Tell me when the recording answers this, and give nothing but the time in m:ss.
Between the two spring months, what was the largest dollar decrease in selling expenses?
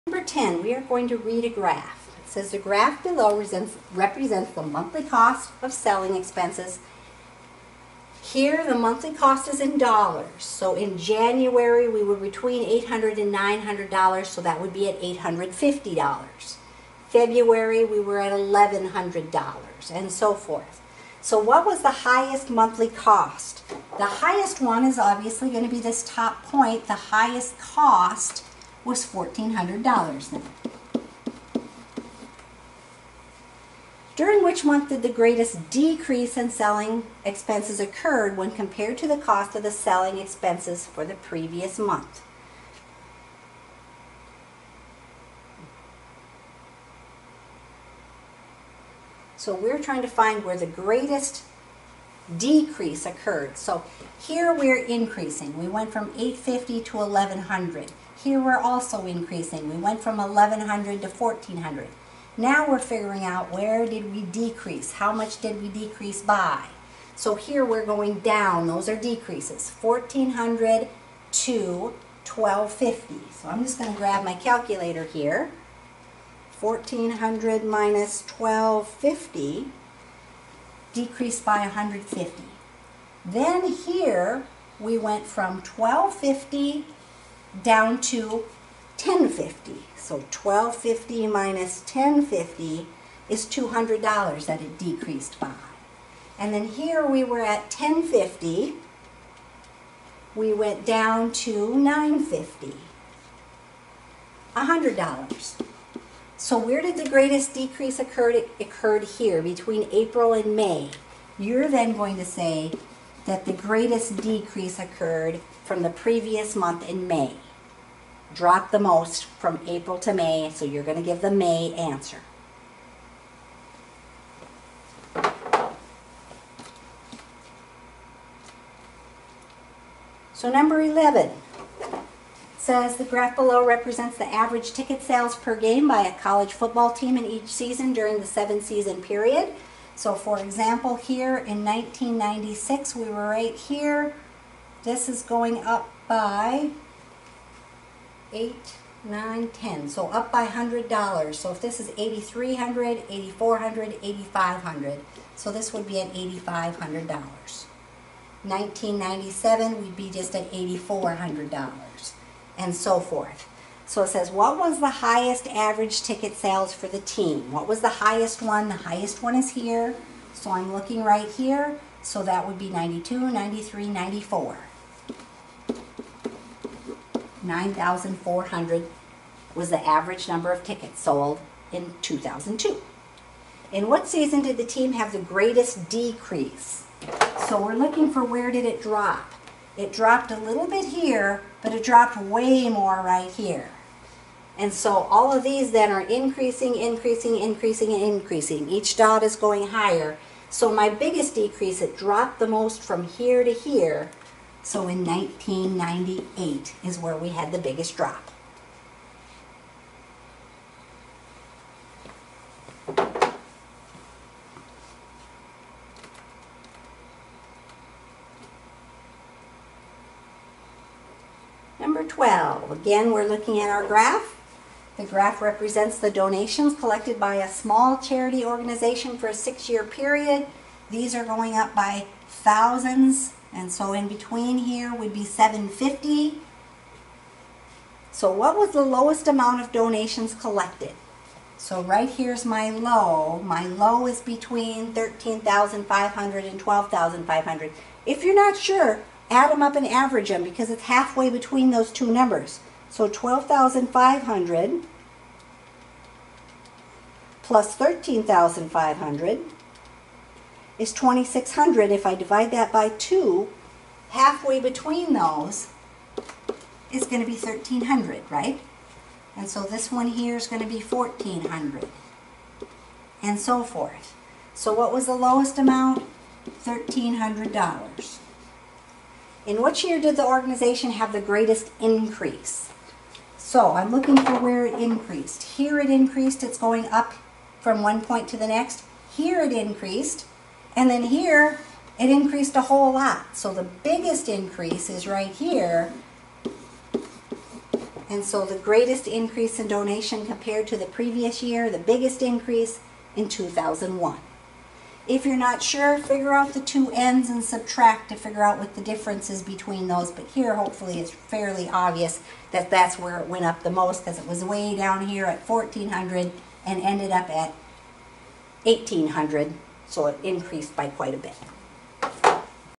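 1:33.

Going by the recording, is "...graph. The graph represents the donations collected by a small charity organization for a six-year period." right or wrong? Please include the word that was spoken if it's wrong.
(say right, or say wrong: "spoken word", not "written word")
right.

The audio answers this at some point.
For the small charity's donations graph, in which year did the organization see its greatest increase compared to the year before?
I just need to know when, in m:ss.
5:03.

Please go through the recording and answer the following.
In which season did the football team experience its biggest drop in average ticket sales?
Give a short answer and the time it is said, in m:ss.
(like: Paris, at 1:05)
1998, at 3:25.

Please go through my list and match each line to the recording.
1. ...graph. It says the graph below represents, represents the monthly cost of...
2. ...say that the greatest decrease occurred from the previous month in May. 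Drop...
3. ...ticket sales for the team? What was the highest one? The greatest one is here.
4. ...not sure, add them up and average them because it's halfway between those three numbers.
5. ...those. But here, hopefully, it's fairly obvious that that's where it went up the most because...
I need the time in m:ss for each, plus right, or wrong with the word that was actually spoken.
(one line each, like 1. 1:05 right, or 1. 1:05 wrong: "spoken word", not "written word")
1. 0:01 right
2. 1:52 right
3. 2:46 wrong: "highest", not "greatest"
4. 4:08 wrong: "two", not "three"
5. 5:09 right.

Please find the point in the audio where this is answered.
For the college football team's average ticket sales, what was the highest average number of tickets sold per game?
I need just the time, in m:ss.
2:57.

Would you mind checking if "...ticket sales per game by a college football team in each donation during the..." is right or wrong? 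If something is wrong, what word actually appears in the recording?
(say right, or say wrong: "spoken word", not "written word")
wrong: "season", not "donation".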